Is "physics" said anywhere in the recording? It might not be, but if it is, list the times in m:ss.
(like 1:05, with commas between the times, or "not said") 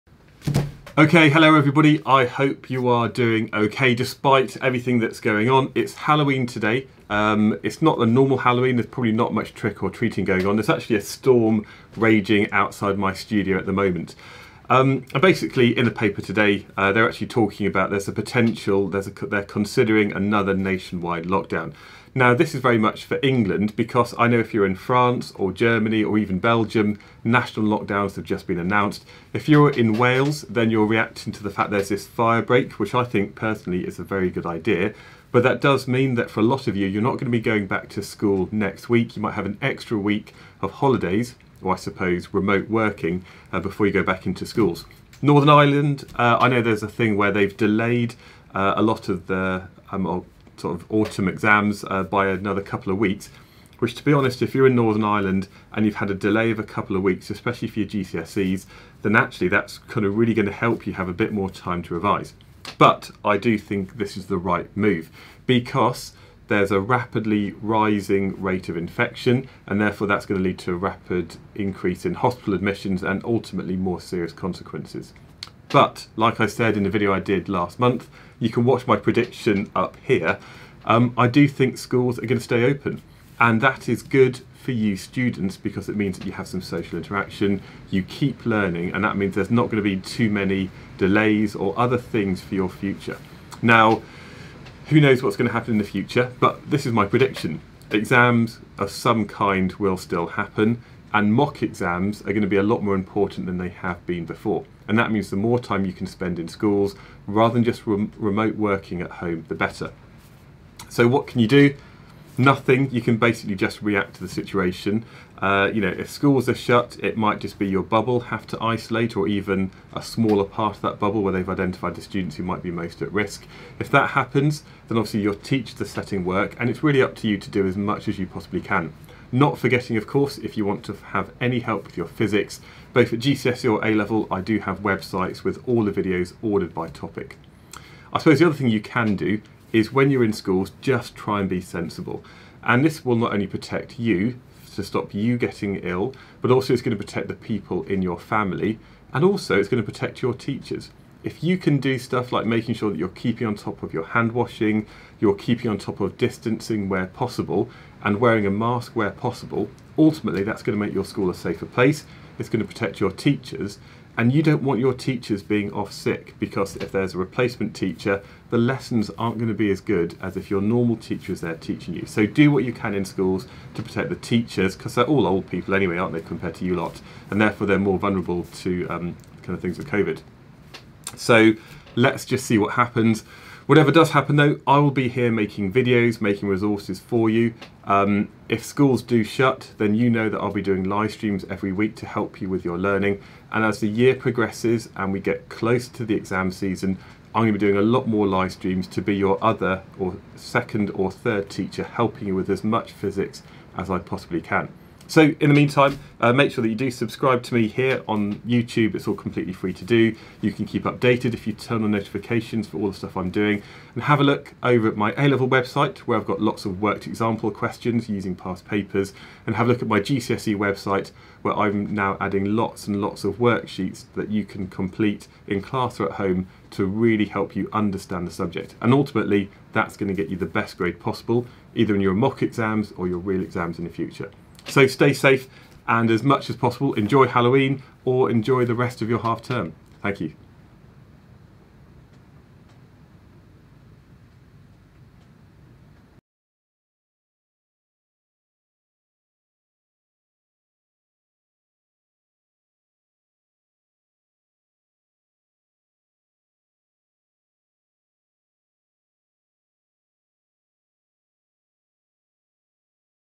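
2:12, 3:22.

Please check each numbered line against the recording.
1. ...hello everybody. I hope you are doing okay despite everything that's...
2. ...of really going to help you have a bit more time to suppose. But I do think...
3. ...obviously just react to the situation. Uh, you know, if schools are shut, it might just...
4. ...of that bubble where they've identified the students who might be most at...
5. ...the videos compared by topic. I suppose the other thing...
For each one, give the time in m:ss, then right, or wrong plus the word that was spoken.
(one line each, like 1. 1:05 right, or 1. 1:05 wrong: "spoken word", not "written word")
1. 0:01 right
2. 1:00 wrong: "revise", not "suppose"
3. 1:53 wrong: "basically", not "obviously"
4. 2:00 right
5. 2:15 wrong: "ordered", not "compared".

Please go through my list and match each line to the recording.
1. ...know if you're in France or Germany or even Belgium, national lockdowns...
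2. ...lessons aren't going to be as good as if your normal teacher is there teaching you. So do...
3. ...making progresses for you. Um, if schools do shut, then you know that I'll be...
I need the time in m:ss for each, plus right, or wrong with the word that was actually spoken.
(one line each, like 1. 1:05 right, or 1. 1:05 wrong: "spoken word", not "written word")
1. 0:24 right
2. 2:48 right
3. 3:06 wrong: "resources", not "progresses".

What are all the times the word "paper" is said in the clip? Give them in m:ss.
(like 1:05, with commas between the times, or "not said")
0:15, 3:38.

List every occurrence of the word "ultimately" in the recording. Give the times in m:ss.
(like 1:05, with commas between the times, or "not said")
1:13, 2:39, 3:48.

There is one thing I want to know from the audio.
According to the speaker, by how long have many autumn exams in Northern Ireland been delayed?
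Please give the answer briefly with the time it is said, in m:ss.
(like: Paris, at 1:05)
a couple of weeks, at 0:56.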